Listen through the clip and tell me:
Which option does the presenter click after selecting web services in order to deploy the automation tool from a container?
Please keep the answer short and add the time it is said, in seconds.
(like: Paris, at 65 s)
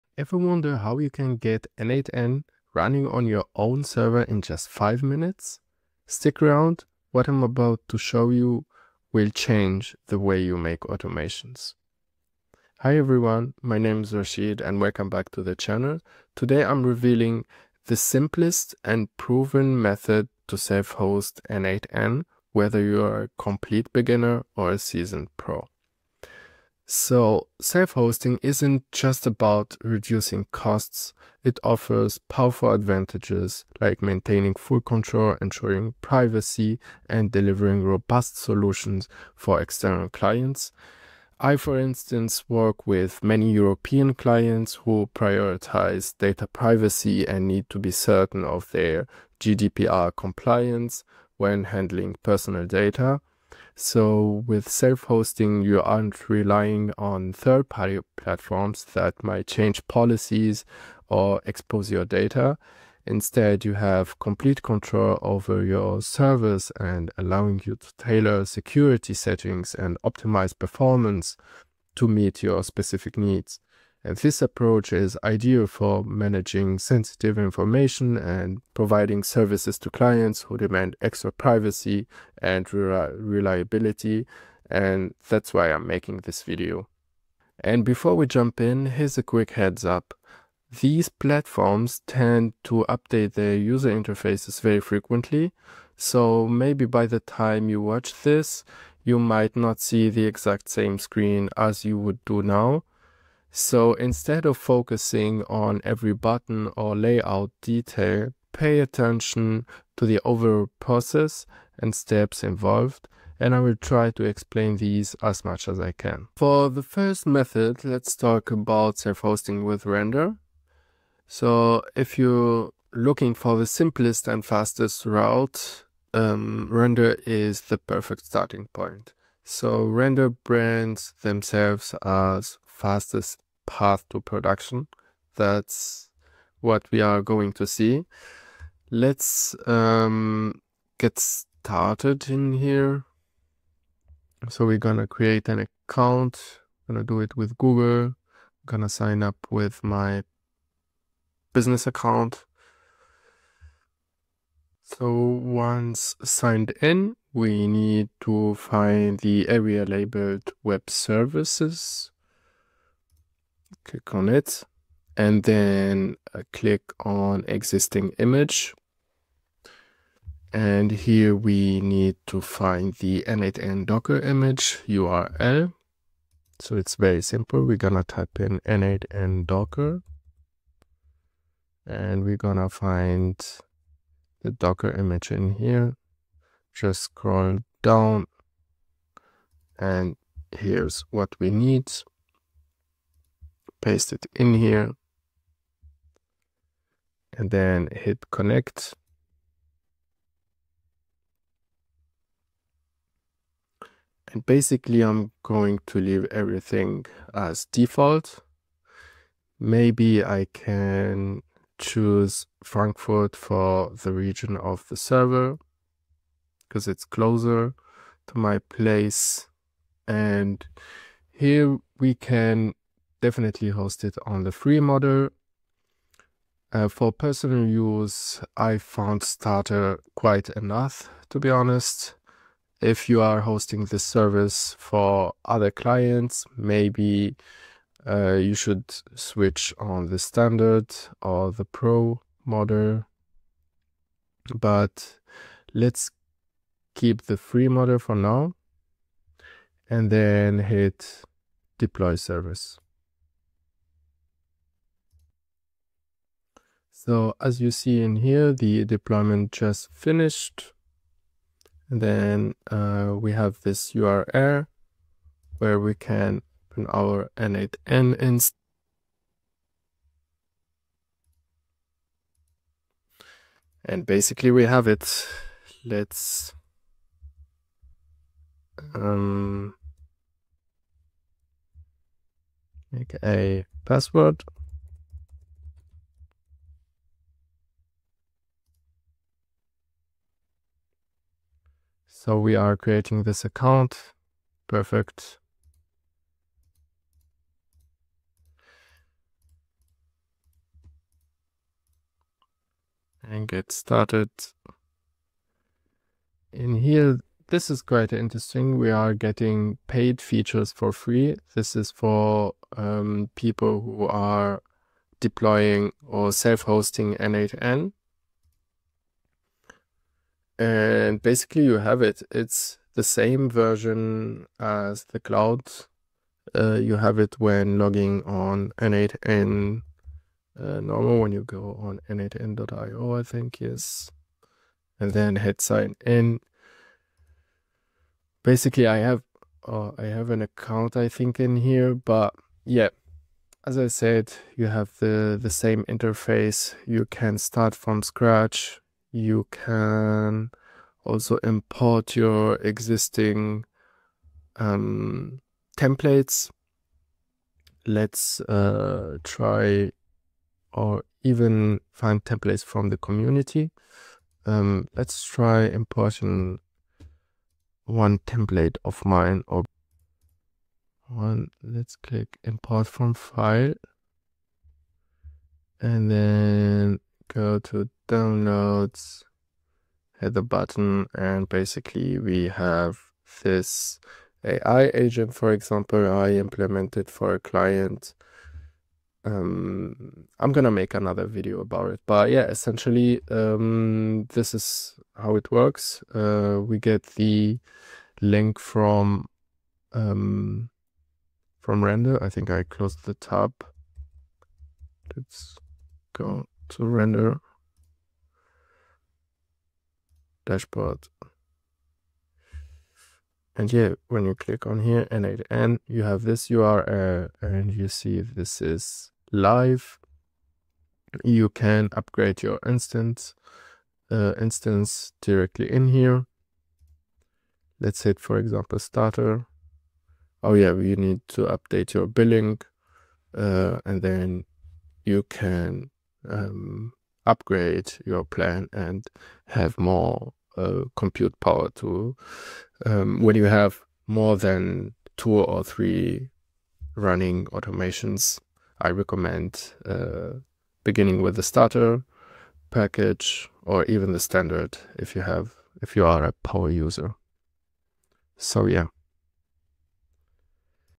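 existing image, at 167 s.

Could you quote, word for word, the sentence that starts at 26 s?
So self-hosting isn't just about reducing costs.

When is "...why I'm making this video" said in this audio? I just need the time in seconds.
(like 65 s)
85 s.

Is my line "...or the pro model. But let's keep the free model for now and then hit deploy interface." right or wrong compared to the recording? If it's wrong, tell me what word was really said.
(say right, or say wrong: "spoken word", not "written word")
wrong: "service", not "interface".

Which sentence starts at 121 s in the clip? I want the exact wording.
So if you're looking for the simplest and fastest route, um, Render is the perfect starting point.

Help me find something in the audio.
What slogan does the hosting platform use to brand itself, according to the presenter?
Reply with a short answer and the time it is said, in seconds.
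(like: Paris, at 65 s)
fastest path to production, at 132 s.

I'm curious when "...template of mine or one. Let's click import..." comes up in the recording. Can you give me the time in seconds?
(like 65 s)
368 s.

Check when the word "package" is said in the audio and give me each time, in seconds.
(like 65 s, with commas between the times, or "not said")
452 s.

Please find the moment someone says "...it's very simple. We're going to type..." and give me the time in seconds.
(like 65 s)
176 s.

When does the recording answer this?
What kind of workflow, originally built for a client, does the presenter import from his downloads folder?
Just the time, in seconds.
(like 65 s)
384 s.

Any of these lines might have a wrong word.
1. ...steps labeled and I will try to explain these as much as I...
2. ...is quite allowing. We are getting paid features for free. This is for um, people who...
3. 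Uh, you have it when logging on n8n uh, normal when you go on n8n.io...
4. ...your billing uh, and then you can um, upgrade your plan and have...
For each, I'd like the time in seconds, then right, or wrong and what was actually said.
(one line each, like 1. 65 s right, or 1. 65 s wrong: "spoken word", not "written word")
1. 111 s wrong: "involved", not "labeled"
2. 307 s wrong: "interesting", not "allowing"
3. 326 s right
4. 431 s right.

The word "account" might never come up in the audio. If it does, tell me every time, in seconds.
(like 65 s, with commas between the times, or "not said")
145 s, 151 s, 293 s, 340 s.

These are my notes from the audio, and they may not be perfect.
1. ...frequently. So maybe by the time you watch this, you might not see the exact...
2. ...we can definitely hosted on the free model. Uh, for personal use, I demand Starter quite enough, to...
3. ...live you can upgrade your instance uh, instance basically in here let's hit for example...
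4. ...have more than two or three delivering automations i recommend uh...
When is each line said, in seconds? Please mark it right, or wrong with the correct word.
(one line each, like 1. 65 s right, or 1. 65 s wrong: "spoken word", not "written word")
1. 94 s right
2. 221 s wrong: "found", not "demand"
3. 419 s wrong: "directly", not "basically"
4. 443 s wrong: "running", not "delivering".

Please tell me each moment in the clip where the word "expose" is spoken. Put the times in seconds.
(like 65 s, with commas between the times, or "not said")
61 s.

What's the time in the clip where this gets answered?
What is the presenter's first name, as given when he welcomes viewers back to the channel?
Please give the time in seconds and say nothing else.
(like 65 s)
14 s.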